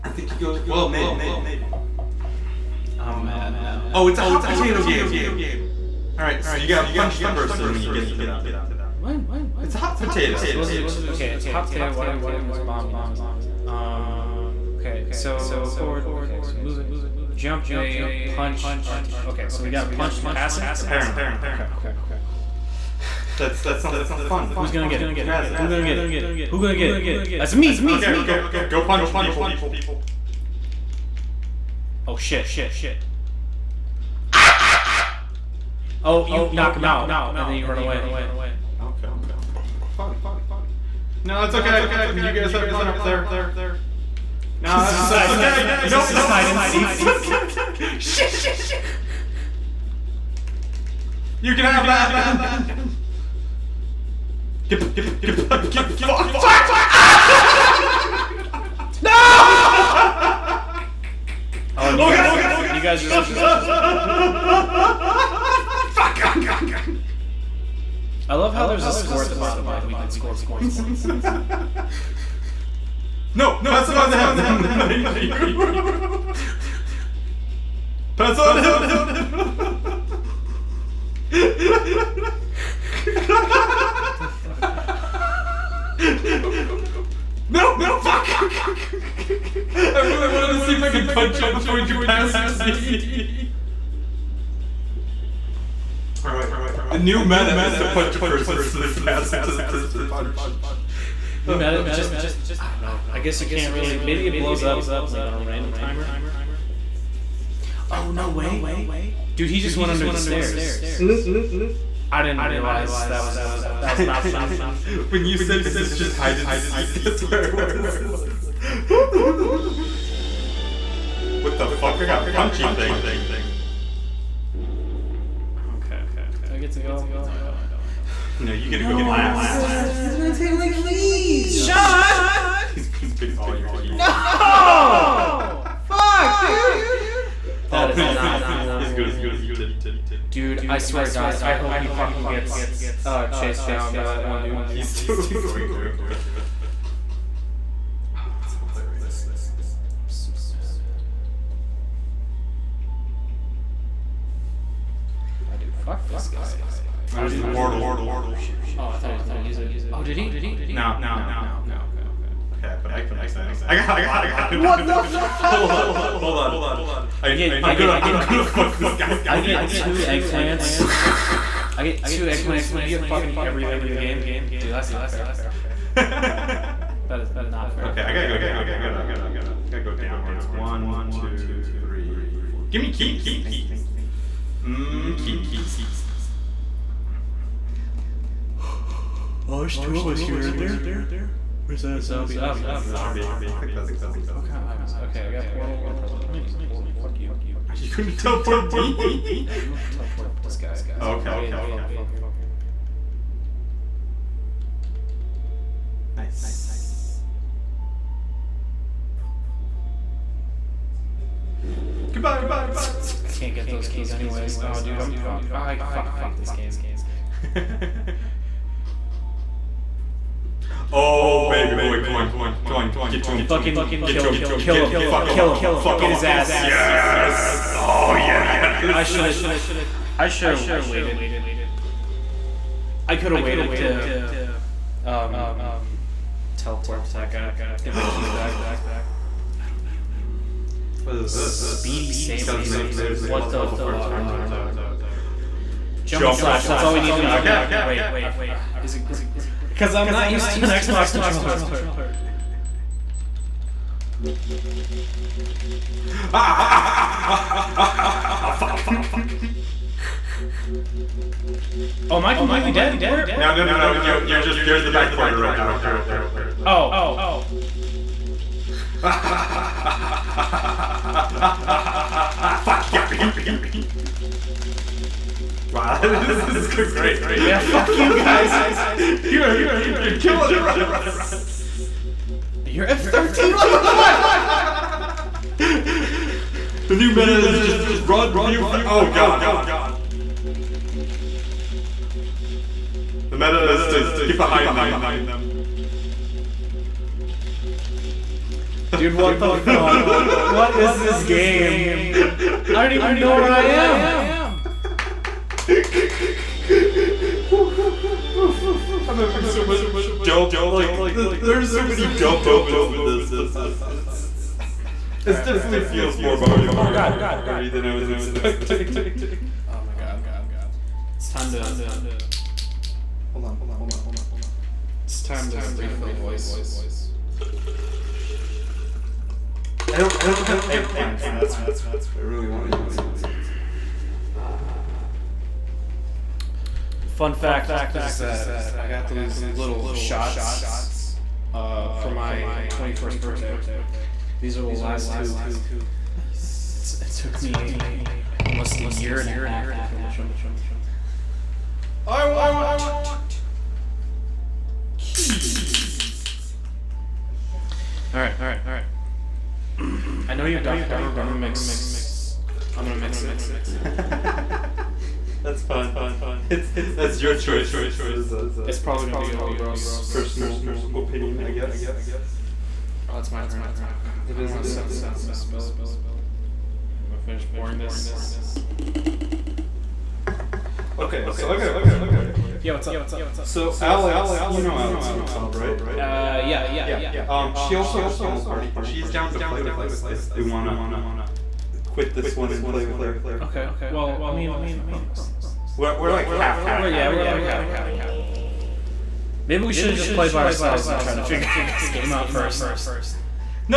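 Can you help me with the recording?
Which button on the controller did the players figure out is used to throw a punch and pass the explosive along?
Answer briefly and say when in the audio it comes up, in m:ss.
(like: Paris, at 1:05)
R2, at 0:18.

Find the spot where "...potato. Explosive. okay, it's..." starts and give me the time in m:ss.
0:09.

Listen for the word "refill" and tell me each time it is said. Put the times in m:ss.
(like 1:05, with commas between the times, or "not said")
5:25.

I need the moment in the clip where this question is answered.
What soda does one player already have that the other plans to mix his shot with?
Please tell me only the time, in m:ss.
6:00.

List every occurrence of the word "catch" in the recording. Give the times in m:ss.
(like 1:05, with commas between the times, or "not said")
not said.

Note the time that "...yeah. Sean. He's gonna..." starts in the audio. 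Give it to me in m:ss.
2:11.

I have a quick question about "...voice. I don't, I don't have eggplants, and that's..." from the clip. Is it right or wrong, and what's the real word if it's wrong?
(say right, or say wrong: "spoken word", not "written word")
right.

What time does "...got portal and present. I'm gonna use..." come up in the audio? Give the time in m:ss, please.
3:15.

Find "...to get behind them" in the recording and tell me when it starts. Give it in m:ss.
4:53.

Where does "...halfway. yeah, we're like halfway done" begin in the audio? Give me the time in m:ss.
6:36.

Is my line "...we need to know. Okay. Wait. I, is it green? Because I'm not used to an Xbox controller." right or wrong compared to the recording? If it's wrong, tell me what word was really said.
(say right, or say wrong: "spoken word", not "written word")
right.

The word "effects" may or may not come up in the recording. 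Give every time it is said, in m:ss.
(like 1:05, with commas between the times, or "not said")
not said.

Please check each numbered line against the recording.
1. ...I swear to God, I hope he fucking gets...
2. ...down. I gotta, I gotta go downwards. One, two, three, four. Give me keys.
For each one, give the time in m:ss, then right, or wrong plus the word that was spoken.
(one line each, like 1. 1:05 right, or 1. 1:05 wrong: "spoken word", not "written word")
1. 2:20 right
2. 2:58 right.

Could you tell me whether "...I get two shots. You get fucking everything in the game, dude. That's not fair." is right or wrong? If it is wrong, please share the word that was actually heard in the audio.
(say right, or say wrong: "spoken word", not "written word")
wrong: "eggplants", not "shots".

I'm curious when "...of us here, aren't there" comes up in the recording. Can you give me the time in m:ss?
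3:09.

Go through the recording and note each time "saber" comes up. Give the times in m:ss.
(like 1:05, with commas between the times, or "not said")
4:02.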